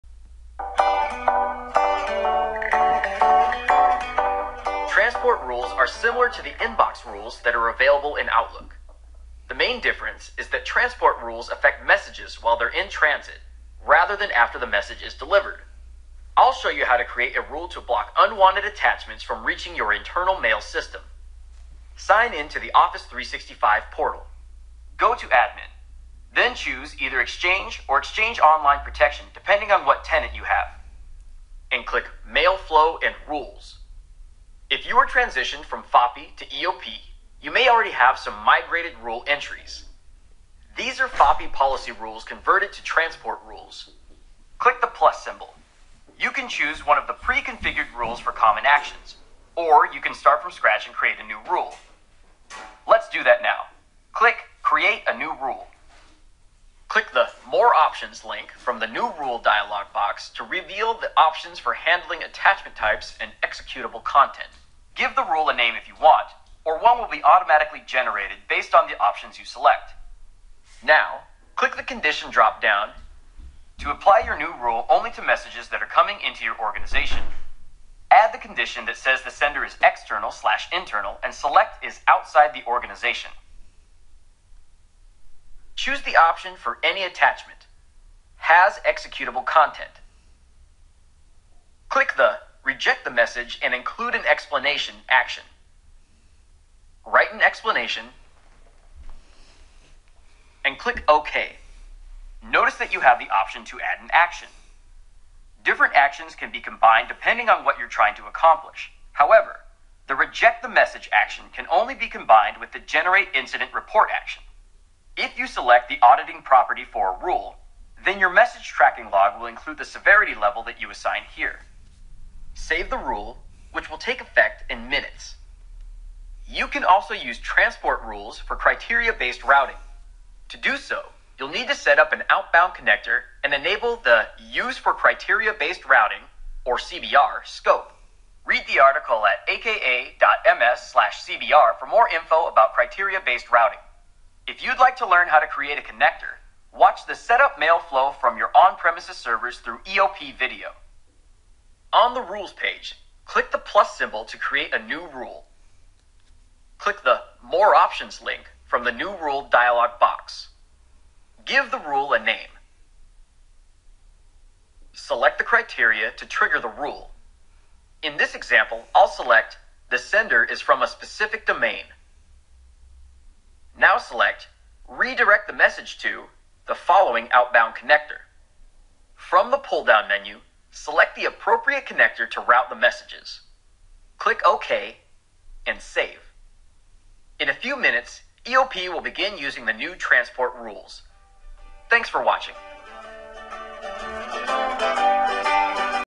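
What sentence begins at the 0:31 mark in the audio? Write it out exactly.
And click Mail Flow and Rules you are transitioned from FOPE to EOP, you may already have some migrated rule entries.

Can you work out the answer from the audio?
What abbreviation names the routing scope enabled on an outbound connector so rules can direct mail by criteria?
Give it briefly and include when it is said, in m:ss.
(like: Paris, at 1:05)
CBR, at 2:16.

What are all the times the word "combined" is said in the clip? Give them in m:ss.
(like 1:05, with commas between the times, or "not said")
1:46, 1:52.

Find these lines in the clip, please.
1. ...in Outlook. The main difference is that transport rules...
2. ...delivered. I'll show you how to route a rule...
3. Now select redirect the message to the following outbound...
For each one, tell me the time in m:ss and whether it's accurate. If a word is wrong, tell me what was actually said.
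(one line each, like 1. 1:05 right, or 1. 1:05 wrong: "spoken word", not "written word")
1. 0:08 right
2. 0:15 wrong: "create", not "route"
3. 2:53 right.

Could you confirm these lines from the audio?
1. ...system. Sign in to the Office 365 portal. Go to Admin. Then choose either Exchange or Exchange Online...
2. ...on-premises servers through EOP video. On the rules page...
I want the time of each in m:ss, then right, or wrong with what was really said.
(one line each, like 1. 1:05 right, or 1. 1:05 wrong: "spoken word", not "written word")
1. 0:20 right
2. 2:28 right.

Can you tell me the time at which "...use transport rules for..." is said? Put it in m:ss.
2:07.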